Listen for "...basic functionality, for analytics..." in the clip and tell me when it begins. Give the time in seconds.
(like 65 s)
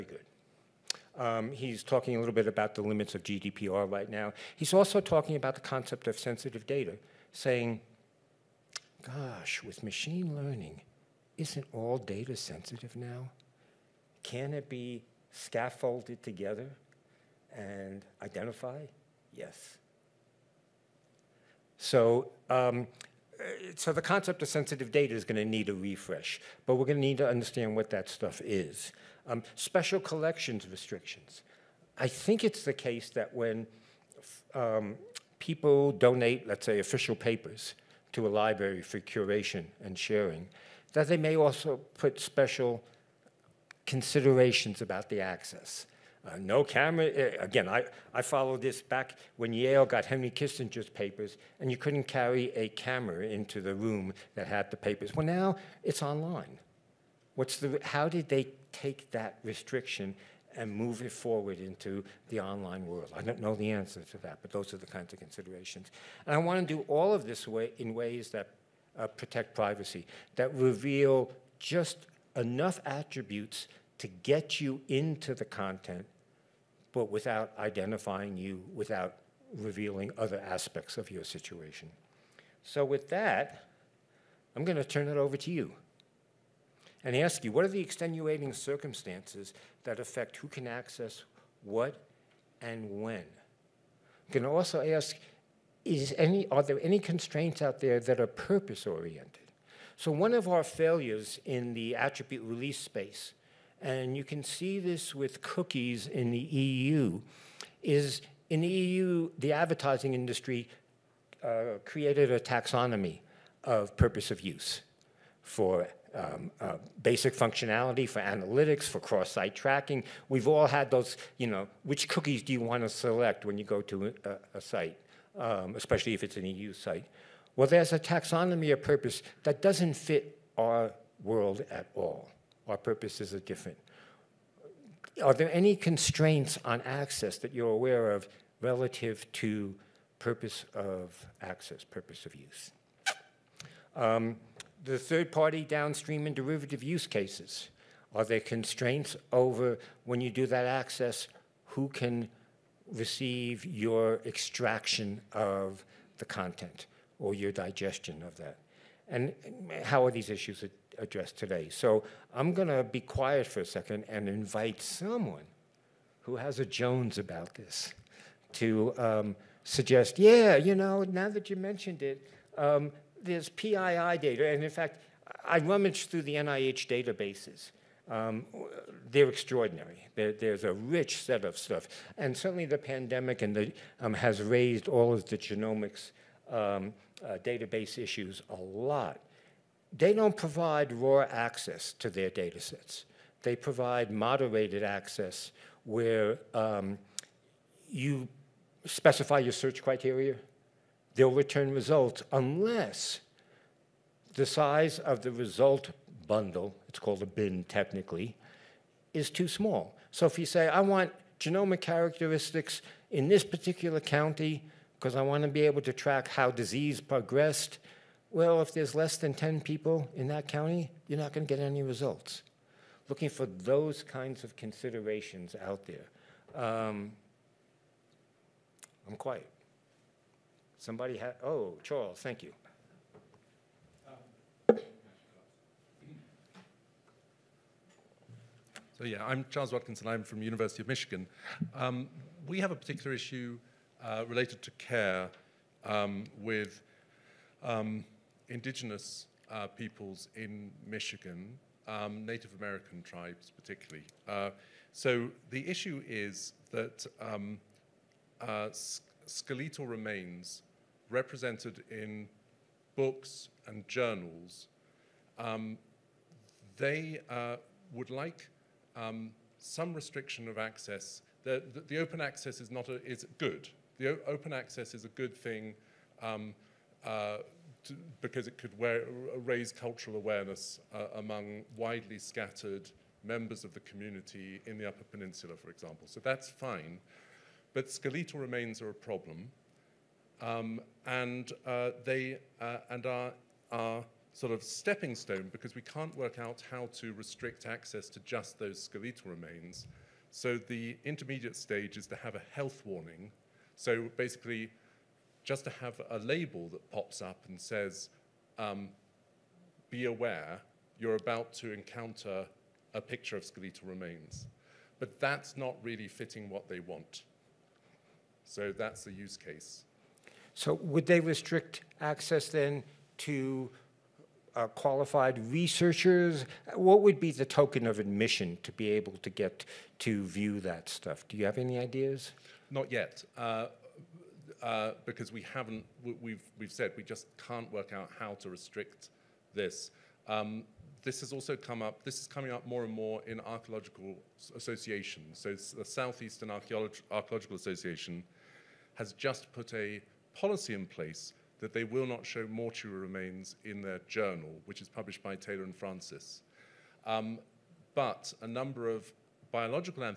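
117 s.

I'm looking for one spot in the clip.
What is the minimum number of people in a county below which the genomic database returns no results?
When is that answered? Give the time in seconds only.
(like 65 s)
219 s.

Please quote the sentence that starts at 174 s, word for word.
And in fact, I rummaged through the NIH databases.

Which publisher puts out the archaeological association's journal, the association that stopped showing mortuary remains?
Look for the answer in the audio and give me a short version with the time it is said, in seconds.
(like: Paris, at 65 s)
Taylor and Francis, at 355 s.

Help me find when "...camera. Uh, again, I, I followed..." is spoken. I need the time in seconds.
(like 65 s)
46 s.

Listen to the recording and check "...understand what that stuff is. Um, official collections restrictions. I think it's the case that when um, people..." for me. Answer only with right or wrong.
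wrong.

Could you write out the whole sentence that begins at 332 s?
Not yet, uh, uh, because we haven't, we've, we've said we just can't work out how to restrict this.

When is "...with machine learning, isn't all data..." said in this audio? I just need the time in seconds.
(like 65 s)
9 s.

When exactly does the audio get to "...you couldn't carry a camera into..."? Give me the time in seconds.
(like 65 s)
51 s.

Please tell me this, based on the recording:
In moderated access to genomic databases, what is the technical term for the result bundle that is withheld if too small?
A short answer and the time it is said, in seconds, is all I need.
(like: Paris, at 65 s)
bin, at 207 s.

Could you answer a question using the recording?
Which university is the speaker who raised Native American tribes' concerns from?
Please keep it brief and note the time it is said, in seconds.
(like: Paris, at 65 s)
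University of Michigan, at 240 s.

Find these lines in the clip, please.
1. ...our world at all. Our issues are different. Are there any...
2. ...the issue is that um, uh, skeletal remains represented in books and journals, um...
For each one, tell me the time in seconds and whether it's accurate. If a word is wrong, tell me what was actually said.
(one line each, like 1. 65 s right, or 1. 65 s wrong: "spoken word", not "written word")
1. 130 s wrong: "purposes", not "issues"
2. 255 s right.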